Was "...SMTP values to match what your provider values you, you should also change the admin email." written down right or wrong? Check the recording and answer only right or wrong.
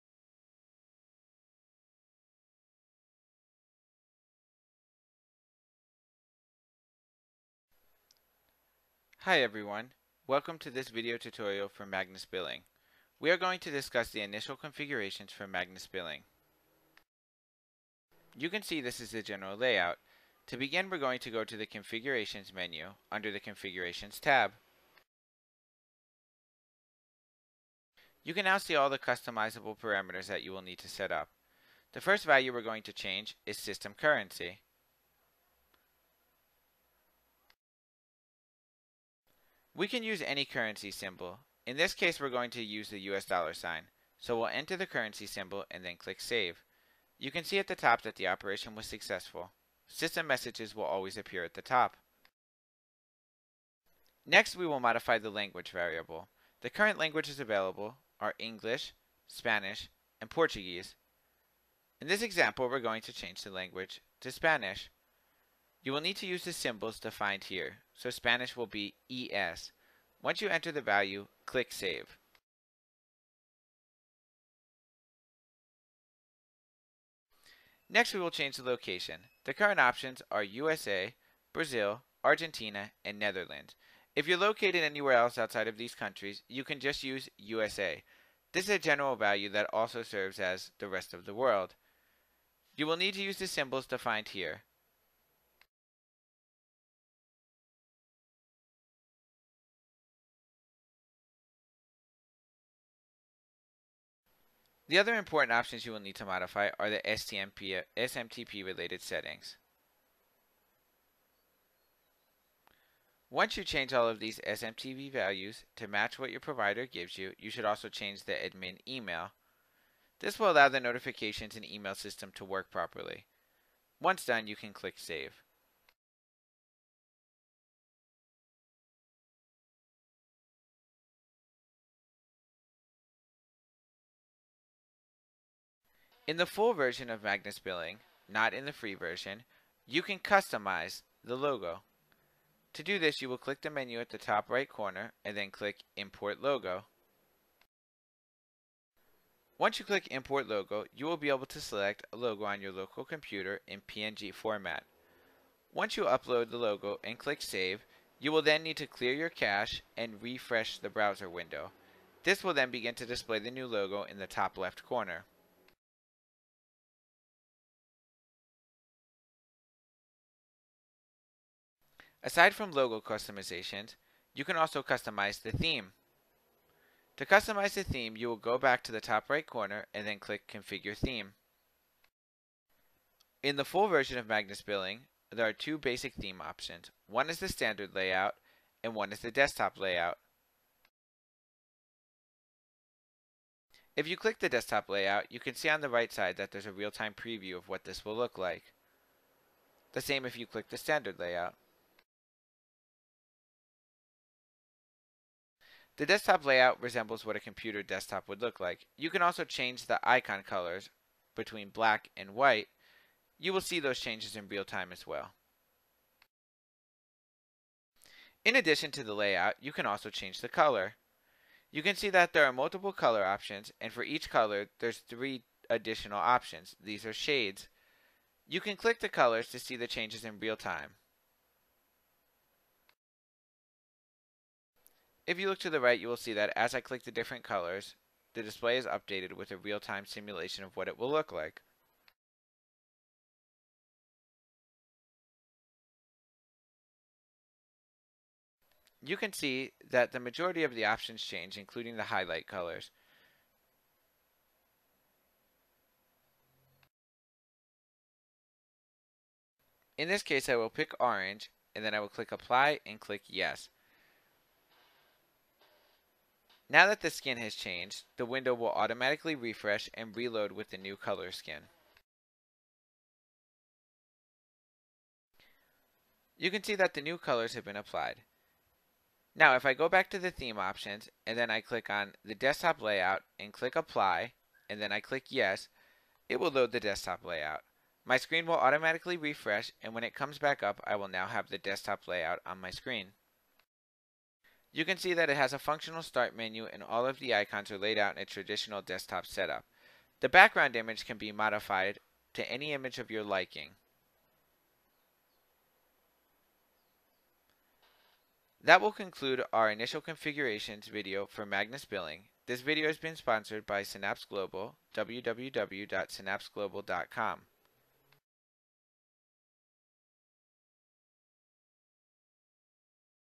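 wrong.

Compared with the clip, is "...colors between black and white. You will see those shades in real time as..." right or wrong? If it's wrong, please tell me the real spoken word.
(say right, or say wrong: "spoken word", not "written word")
wrong: "changes", not "shades".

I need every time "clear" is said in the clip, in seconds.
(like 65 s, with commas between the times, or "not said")
158 s.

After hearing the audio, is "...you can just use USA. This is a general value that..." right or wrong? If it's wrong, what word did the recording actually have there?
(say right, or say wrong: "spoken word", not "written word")
right.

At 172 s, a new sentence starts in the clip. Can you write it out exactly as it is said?
Aside from logo customizations, you can also customize the theme.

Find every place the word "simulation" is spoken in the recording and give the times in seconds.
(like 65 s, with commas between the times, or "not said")
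240 s.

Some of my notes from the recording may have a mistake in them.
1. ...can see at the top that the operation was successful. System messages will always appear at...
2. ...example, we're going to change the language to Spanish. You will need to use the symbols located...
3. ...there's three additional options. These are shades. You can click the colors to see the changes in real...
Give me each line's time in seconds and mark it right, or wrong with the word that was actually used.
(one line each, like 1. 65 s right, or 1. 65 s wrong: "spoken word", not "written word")
1. 47 s right
2. 62 s wrong: "defined", not "located"
3. 224 s right.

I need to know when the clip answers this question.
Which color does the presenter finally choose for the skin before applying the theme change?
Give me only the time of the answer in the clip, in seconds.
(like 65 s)
260 s.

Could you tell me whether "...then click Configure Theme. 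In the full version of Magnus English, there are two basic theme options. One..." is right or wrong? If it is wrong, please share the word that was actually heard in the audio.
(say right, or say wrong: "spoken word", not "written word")
wrong: "Billing", not "English".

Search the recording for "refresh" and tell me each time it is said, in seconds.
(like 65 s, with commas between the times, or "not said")
160 s, 269 s, 289 s.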